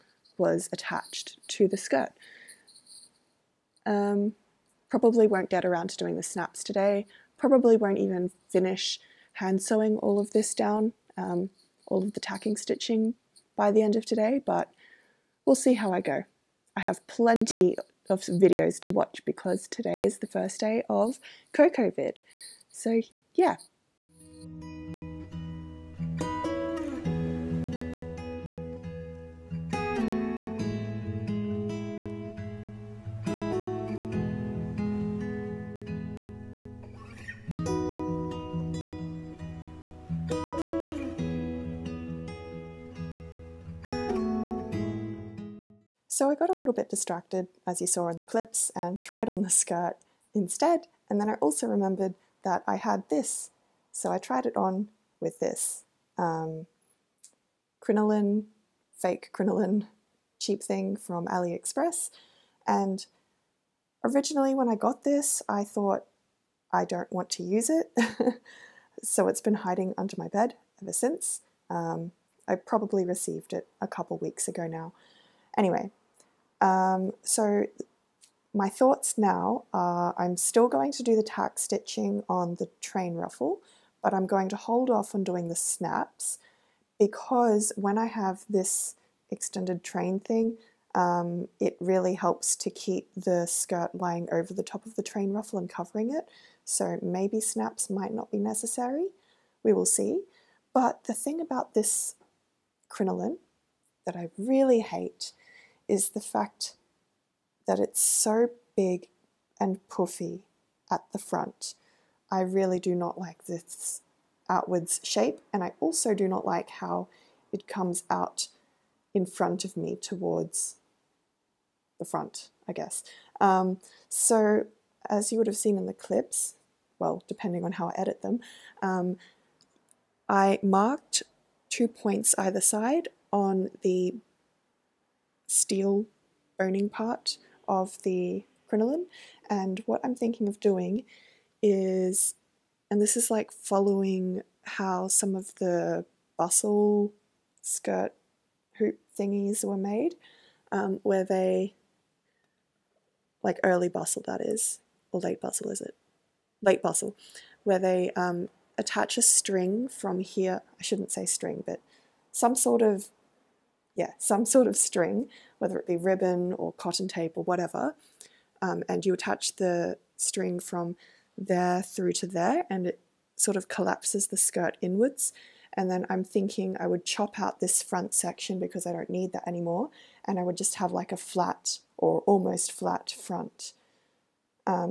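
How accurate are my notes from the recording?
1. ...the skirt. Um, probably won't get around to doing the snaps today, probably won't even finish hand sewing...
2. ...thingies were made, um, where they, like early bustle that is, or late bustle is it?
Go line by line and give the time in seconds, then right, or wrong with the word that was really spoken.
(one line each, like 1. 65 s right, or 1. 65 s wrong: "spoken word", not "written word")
1. 1 s right
2. 149 s right.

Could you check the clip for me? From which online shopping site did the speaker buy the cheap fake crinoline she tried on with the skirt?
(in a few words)
AliExpress.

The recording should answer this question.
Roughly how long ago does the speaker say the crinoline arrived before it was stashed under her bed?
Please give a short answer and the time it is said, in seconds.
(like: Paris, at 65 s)
a couple weeks, at 73 s.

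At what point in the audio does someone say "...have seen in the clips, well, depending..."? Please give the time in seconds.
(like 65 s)
125 s.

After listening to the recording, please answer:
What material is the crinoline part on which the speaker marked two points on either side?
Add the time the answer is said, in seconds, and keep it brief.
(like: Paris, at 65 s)
steel boning, at 135 s.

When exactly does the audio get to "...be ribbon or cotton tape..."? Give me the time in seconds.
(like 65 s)
165 s.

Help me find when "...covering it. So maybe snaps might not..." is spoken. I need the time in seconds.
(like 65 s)
95 s.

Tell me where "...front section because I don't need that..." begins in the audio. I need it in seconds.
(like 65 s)
177 s.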